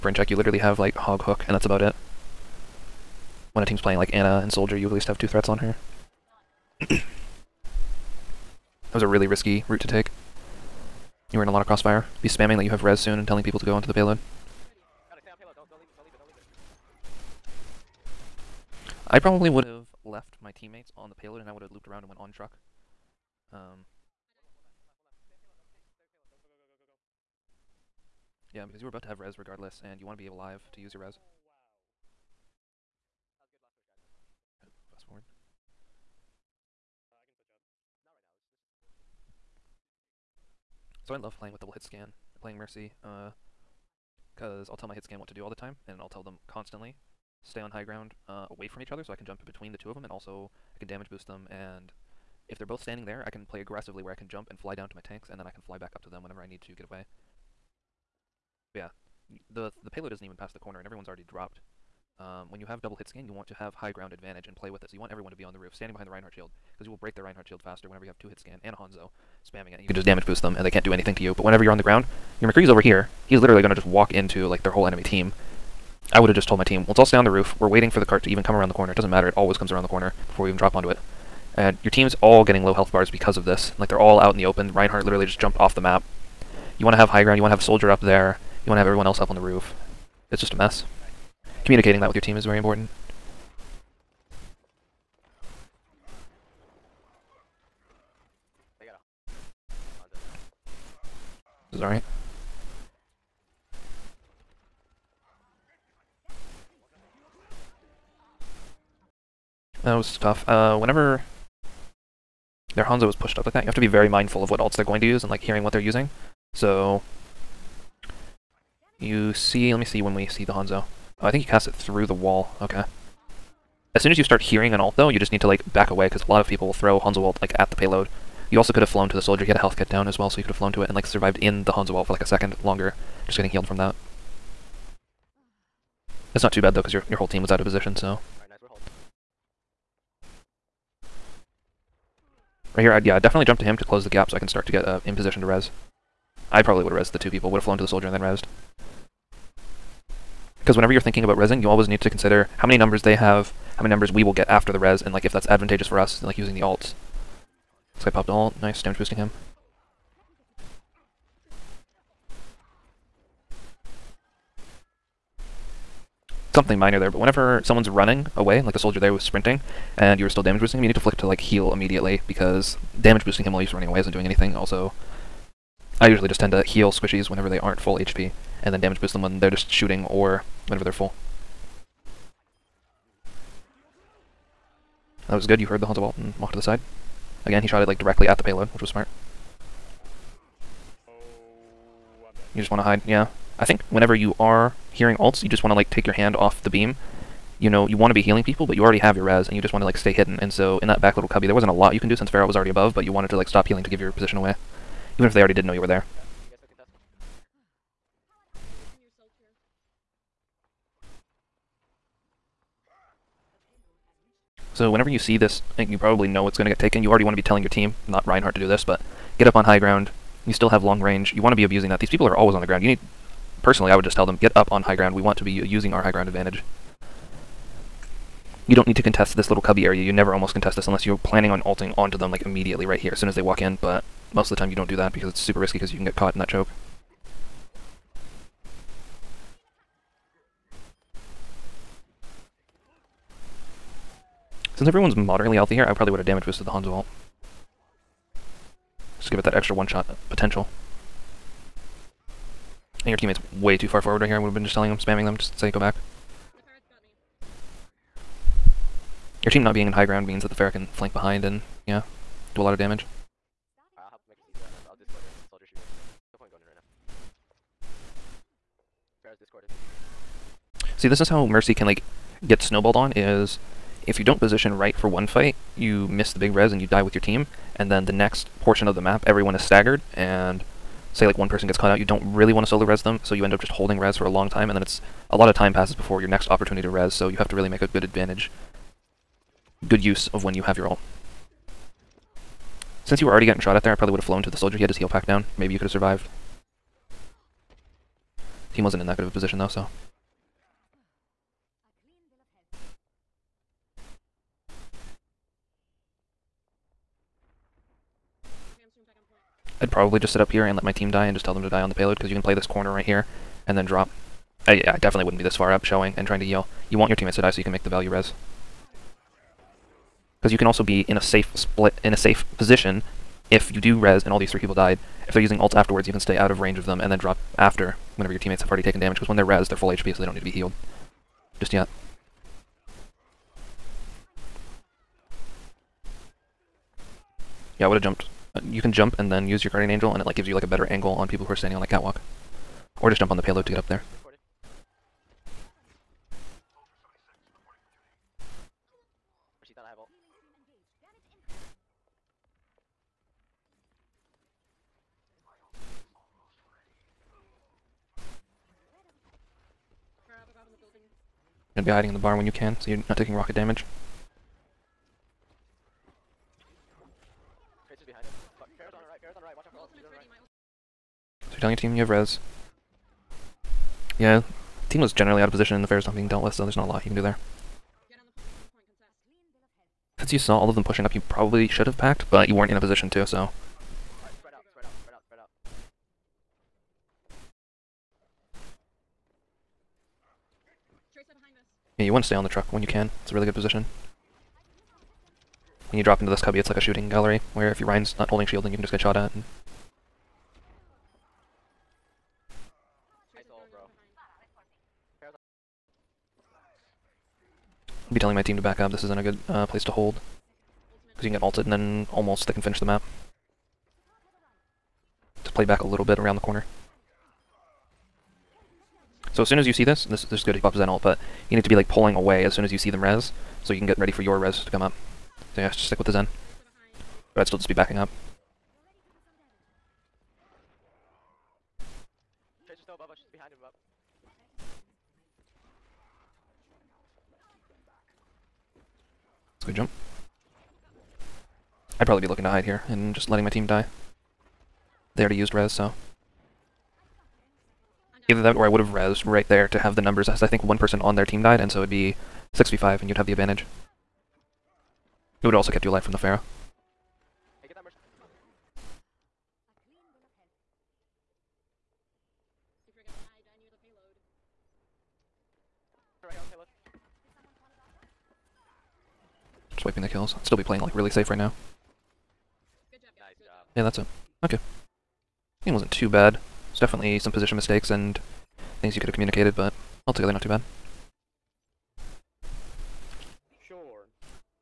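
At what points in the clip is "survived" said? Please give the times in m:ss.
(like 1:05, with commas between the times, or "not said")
2:11, 4:55.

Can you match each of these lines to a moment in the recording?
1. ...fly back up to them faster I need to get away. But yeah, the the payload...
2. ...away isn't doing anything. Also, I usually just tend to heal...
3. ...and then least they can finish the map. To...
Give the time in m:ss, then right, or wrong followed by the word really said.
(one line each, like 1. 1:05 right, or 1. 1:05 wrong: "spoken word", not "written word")
1. 0:55 wrong: "whenever", not "faster"
2. 2:53 right
3. 6:51 wrong: "almost", not "least".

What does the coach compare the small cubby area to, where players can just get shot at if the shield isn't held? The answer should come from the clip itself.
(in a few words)
a shooting gallery.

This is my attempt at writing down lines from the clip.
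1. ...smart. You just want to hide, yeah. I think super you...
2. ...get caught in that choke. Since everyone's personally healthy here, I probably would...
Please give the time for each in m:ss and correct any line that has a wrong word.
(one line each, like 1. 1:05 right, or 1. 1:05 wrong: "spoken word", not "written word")
1. 3:08 wrong: "whenever", not "super"
2. 3:56 wrong: "moderately", not "personally".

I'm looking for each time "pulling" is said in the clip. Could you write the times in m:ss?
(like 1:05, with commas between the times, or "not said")
7:01.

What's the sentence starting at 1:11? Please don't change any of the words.
But whenever you're on the ground, your McCree's over here.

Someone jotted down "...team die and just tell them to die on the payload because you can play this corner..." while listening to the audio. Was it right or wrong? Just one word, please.
right.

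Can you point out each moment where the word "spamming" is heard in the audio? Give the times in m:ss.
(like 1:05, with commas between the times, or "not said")
0:12, 1:09, 4:14.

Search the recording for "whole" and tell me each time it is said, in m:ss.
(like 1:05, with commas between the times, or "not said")
1:14, 2:17.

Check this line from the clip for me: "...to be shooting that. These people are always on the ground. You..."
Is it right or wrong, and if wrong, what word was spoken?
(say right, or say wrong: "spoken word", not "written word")
wrong: "abusing", not "shooting".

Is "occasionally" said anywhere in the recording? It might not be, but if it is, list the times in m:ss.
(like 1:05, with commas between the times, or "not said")
not said.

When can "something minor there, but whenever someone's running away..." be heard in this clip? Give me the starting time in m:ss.
2:46.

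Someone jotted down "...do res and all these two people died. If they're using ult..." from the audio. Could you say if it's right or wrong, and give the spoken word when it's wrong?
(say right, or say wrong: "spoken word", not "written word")
wrong: "three", not "two".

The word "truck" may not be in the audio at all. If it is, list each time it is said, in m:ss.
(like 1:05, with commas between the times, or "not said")
0:22, 6:32.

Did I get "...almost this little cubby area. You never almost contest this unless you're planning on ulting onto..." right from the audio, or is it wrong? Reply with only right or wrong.
wrong.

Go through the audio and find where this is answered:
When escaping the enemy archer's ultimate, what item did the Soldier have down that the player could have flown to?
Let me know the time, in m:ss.
2:09.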